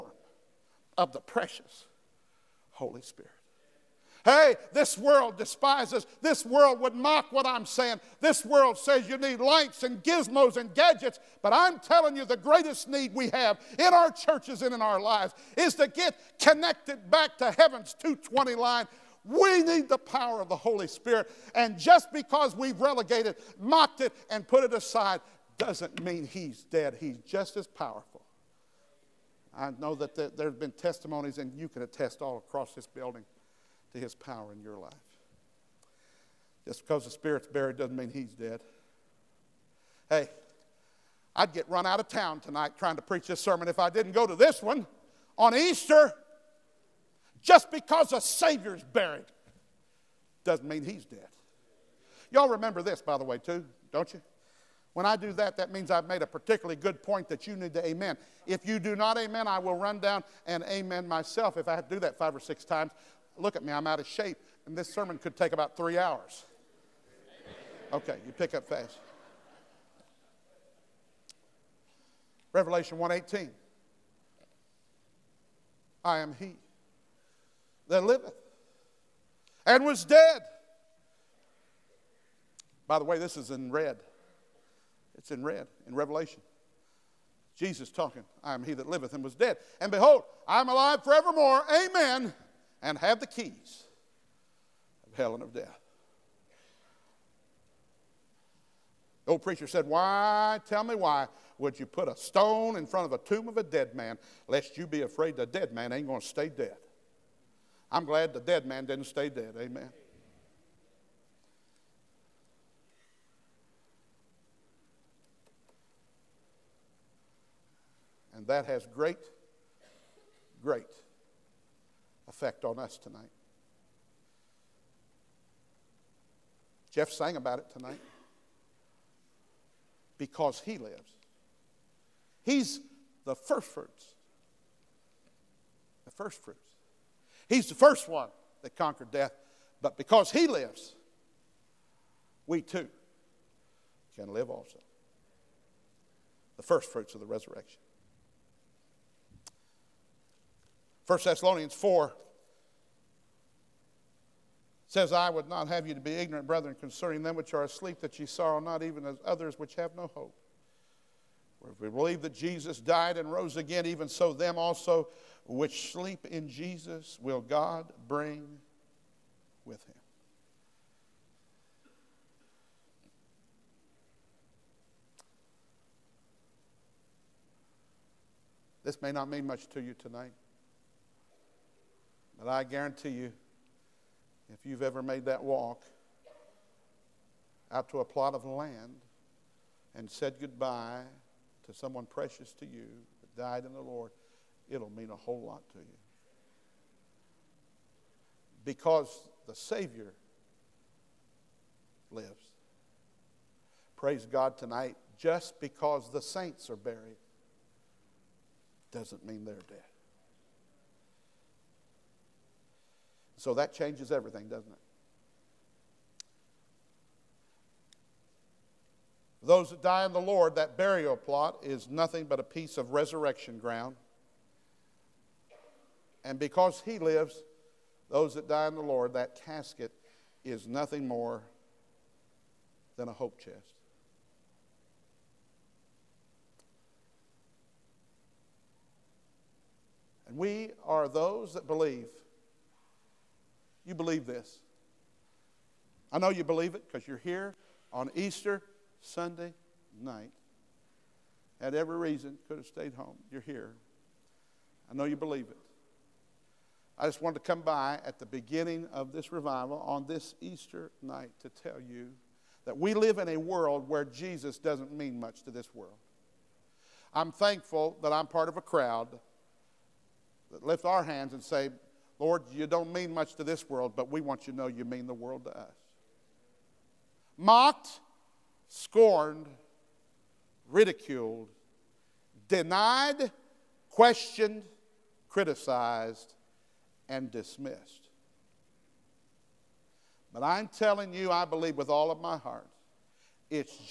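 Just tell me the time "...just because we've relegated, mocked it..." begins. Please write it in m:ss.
0:21.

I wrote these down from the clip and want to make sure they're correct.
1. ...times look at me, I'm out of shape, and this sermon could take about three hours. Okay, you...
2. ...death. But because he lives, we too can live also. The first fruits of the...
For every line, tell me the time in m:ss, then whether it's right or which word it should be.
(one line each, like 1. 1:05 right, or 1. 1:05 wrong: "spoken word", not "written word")
1. 1:02 right
2. 2:19 right.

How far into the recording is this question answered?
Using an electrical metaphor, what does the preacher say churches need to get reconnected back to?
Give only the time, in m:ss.
0:17.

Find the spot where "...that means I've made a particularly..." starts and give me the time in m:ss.
0:55.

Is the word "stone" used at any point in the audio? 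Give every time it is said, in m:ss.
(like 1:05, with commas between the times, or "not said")
1:42.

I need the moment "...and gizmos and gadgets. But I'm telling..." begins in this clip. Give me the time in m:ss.
0:09.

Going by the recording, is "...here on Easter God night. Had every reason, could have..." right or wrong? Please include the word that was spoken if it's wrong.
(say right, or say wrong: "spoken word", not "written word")
wrong: "Sunday", not "God".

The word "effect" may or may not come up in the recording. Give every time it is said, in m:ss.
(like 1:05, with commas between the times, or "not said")
2:02.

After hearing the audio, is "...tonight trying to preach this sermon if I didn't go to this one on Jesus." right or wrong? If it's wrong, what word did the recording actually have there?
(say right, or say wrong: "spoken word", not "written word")
wrong: "Easter", not "Jesus".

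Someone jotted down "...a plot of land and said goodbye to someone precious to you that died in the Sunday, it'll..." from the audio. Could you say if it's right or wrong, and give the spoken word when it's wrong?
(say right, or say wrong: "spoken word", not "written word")
wrong: "Lord", not "Sunday".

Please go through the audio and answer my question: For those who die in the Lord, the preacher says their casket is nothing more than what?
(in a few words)
A hope chest.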